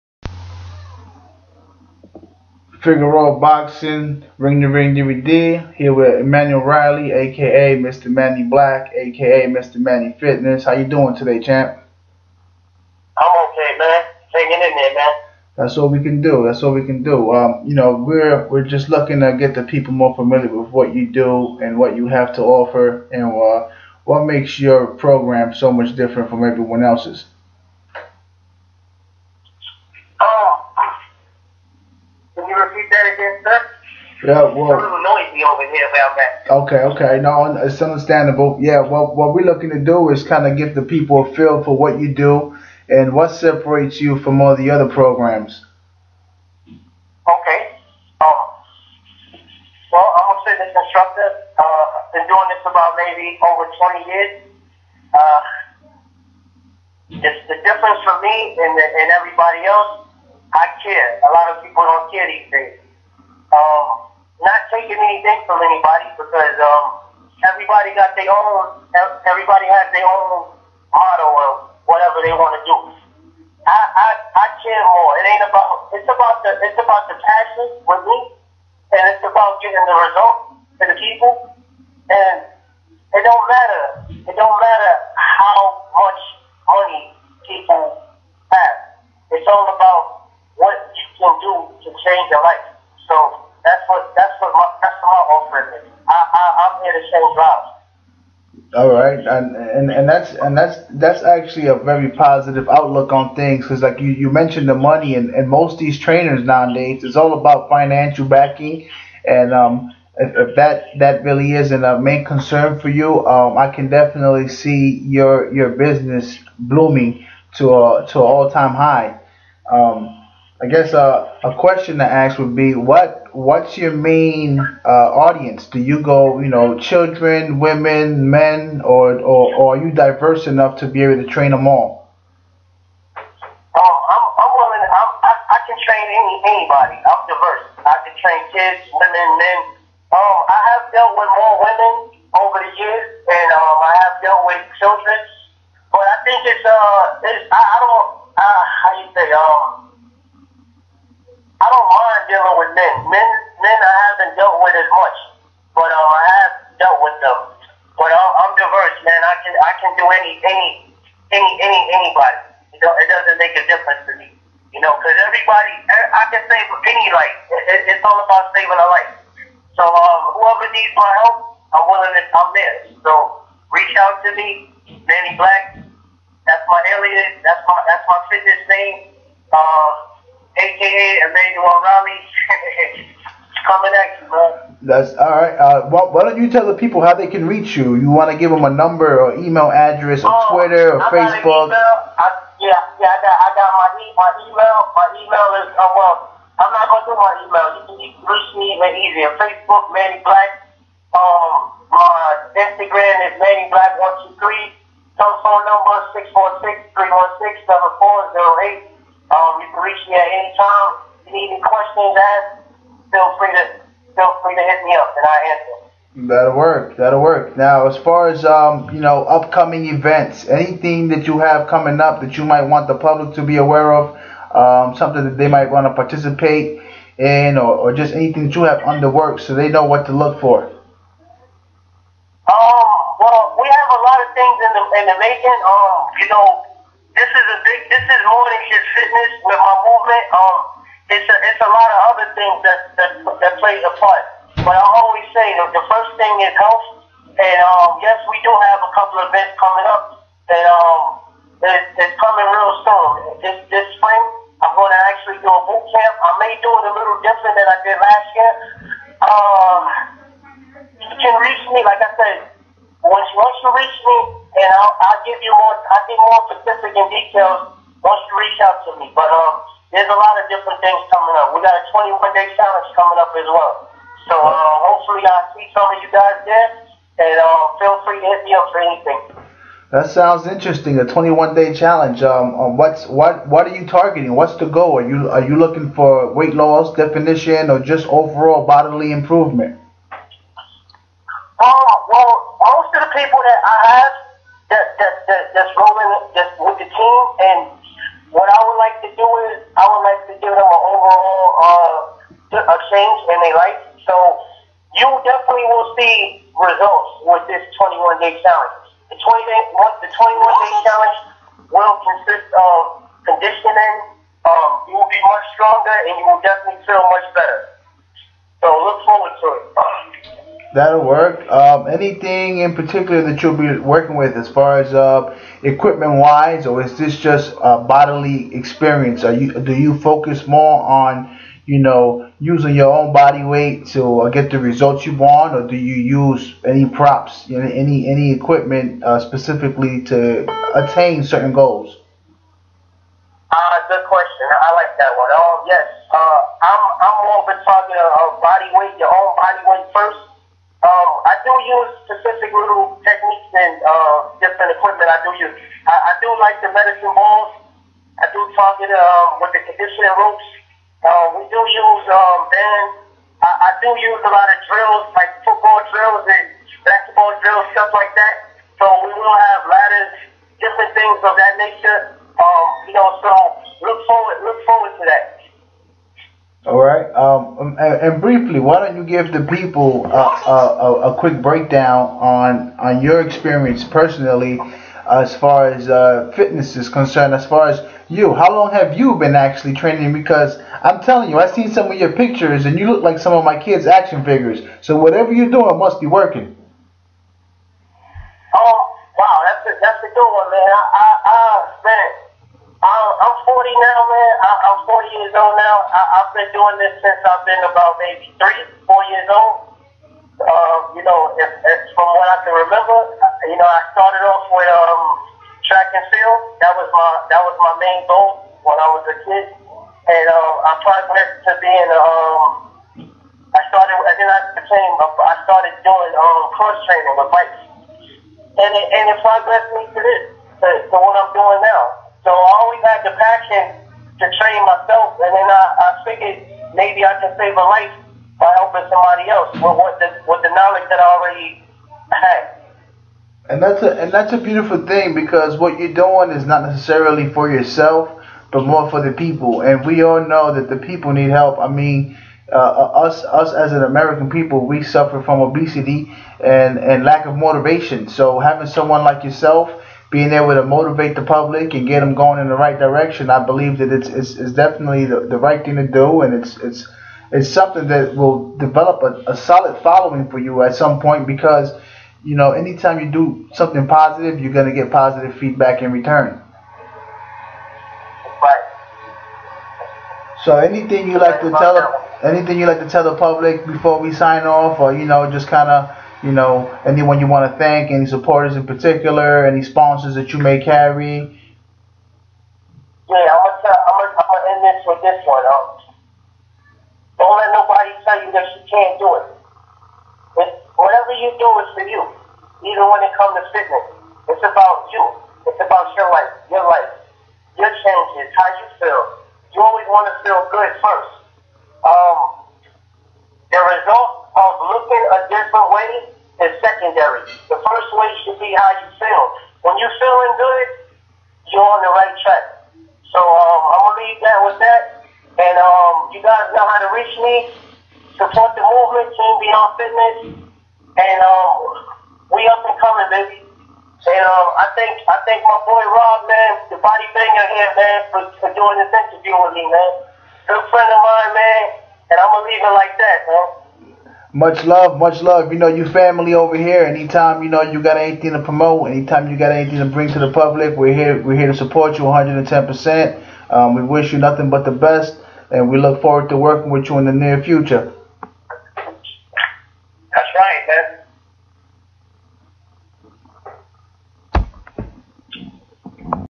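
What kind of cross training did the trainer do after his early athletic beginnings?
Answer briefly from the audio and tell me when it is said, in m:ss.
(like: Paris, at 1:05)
bikes, at 7:07.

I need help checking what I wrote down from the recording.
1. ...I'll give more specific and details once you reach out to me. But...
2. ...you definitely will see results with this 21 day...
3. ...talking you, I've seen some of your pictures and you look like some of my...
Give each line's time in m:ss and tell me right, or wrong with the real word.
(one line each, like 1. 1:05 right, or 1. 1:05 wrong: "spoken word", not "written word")
1. 4:25 right
2. 5:04 right
3. 6:31 wrong: "telling", not "talking".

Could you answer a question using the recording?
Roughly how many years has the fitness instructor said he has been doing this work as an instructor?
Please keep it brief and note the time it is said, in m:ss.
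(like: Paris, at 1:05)
over 20 years, at 0:53.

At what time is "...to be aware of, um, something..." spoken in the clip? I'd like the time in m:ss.
3:43.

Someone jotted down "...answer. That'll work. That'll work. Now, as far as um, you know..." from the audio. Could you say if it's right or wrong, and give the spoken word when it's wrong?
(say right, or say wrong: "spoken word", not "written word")
right.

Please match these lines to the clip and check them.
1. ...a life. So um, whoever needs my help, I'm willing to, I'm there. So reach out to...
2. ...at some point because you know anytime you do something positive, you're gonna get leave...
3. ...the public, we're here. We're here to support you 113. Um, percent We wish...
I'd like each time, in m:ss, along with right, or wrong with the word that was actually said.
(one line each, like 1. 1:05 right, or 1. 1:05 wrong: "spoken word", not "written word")
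1. 2:48 right
2. 7:50 wrong: "positive", not "leave"
3. 9:10 wrong: "110", not "113".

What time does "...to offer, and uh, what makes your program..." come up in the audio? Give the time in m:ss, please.
0:22.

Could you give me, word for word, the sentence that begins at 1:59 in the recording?
Um, I guess uh, a question to ask would be what what's your main uh, audience?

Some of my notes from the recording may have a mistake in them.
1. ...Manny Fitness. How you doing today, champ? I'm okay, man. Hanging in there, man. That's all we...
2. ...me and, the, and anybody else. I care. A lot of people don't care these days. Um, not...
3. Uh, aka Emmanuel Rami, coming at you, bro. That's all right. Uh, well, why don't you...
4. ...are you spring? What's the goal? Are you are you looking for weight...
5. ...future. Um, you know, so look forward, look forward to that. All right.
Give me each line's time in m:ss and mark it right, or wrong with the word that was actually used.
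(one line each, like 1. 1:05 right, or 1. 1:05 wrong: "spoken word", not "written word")
1. 0:09 right
2. 0:58 wrong: "everybody", not "anybody"
3. 2:59 right
4. 4:43 wrong: "targeting", not "spring"
5. 6:11 wrong: "nature", not "future".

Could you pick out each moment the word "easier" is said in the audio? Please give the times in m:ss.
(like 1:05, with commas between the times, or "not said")
3:19.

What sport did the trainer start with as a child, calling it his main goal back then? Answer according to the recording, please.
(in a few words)
track and field.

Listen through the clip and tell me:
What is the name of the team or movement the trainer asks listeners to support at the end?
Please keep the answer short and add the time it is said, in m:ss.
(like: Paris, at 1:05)
Team Beyond Fitness, at 8:49.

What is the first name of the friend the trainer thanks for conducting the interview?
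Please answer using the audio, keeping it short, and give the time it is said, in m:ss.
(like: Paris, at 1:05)
Rob, at 8:55.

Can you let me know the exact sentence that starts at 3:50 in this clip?
Um, well, we have a lot of things in the in the making.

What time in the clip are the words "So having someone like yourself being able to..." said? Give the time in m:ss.
7:38.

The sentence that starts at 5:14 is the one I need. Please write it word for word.
Um, you will be much stronger, and you will definitely feel much better.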